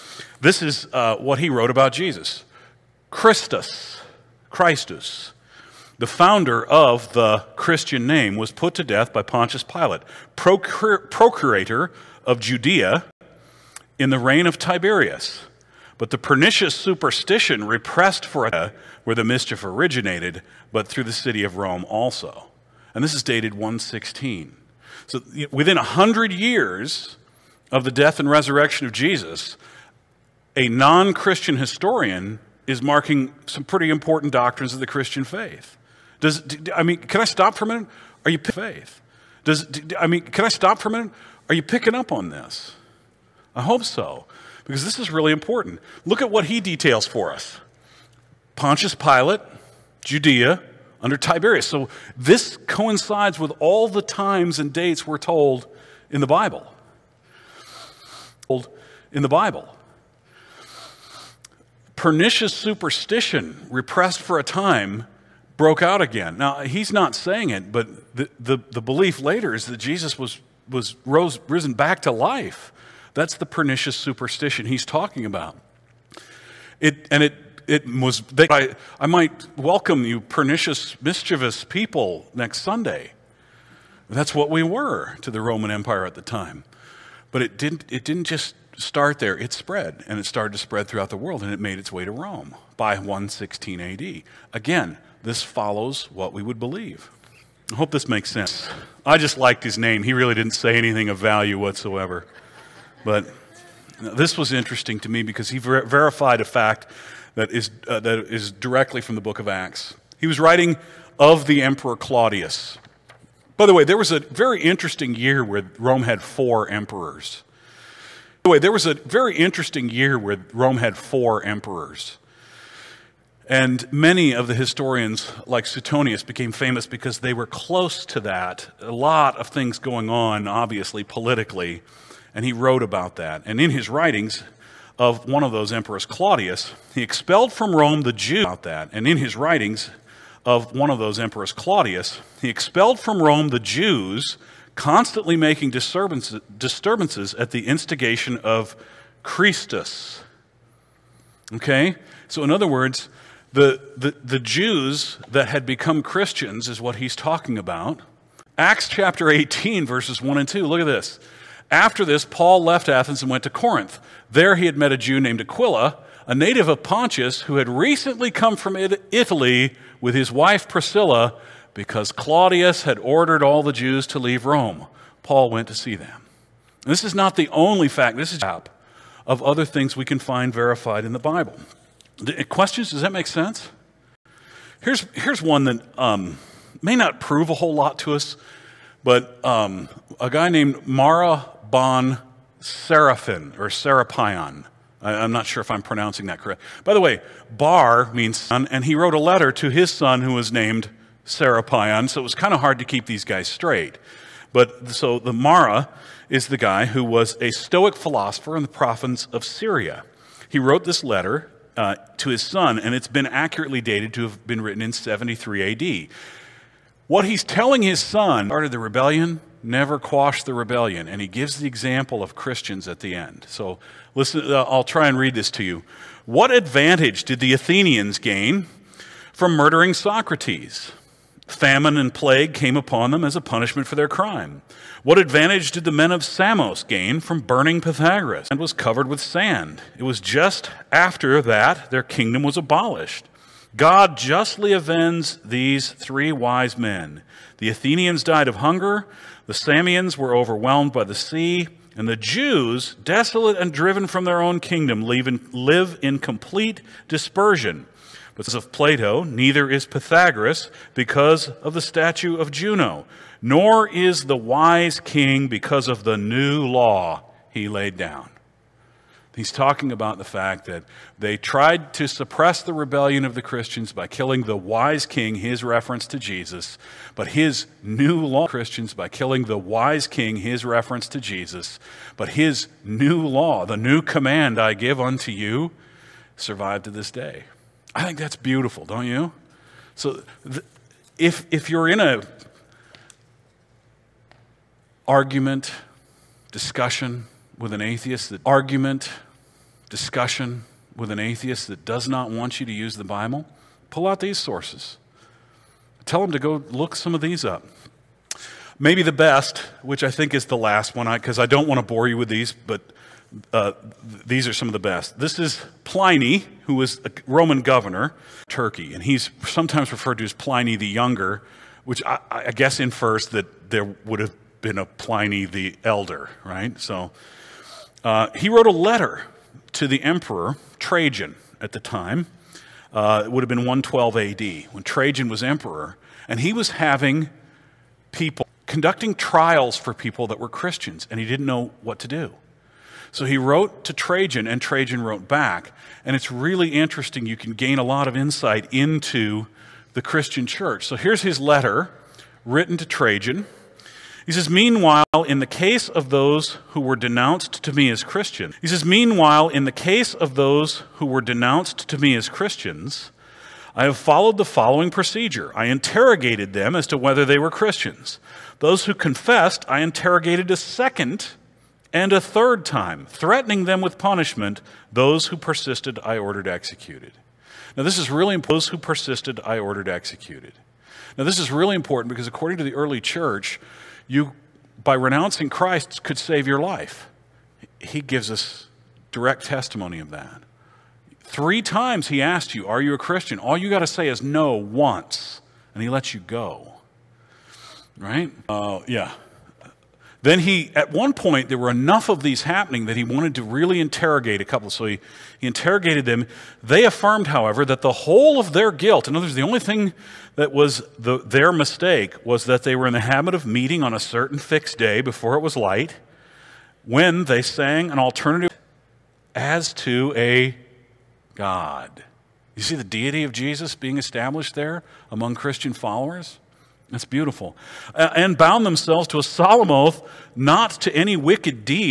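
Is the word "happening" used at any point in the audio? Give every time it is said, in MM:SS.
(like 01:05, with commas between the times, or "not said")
06:42.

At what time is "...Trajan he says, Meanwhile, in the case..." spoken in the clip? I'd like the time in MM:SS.
05:52.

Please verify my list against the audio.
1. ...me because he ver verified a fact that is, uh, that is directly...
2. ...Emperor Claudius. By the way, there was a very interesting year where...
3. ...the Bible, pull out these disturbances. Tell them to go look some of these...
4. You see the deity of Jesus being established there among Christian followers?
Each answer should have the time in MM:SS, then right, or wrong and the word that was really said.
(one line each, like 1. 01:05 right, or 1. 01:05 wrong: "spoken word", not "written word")
1. 01:45 right
2. 01:51 right
3. 05:02 wrong: "sources", not "disturbances"
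4. 07:02 right.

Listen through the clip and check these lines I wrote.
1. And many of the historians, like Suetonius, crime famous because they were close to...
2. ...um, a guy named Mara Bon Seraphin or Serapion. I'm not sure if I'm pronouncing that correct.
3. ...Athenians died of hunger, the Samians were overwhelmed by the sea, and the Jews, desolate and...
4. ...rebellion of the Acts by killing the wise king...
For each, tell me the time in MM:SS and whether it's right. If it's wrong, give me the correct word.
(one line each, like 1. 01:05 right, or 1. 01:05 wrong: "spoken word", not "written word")
1. 02:03 wrong: "became", not "crime"
2. 03:09 right
3. 04:07 right
4. 04:32 wrong: "Christians", not "Acts".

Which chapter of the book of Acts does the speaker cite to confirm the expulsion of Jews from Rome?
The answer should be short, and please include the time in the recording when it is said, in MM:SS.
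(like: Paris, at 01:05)
Chapter 18, at 02:38.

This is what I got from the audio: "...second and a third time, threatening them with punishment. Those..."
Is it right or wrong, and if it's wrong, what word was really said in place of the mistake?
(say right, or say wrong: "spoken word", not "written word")
right.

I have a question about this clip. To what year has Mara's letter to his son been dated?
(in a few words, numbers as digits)
73 AD.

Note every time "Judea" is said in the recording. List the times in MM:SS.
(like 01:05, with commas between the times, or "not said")
00:12, 00:50.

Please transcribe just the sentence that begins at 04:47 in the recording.
I think that's beautiful, don't you?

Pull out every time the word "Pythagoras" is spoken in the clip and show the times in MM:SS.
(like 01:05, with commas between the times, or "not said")
03:57, 04:19.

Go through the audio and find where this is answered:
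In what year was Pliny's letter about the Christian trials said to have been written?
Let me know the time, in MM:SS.
05:33.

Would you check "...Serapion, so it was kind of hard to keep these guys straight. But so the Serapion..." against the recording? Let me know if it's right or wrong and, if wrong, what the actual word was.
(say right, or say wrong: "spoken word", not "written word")
wrong: "Mara", not "Serapion".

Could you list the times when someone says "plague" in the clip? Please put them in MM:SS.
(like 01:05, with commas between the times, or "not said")
03:52.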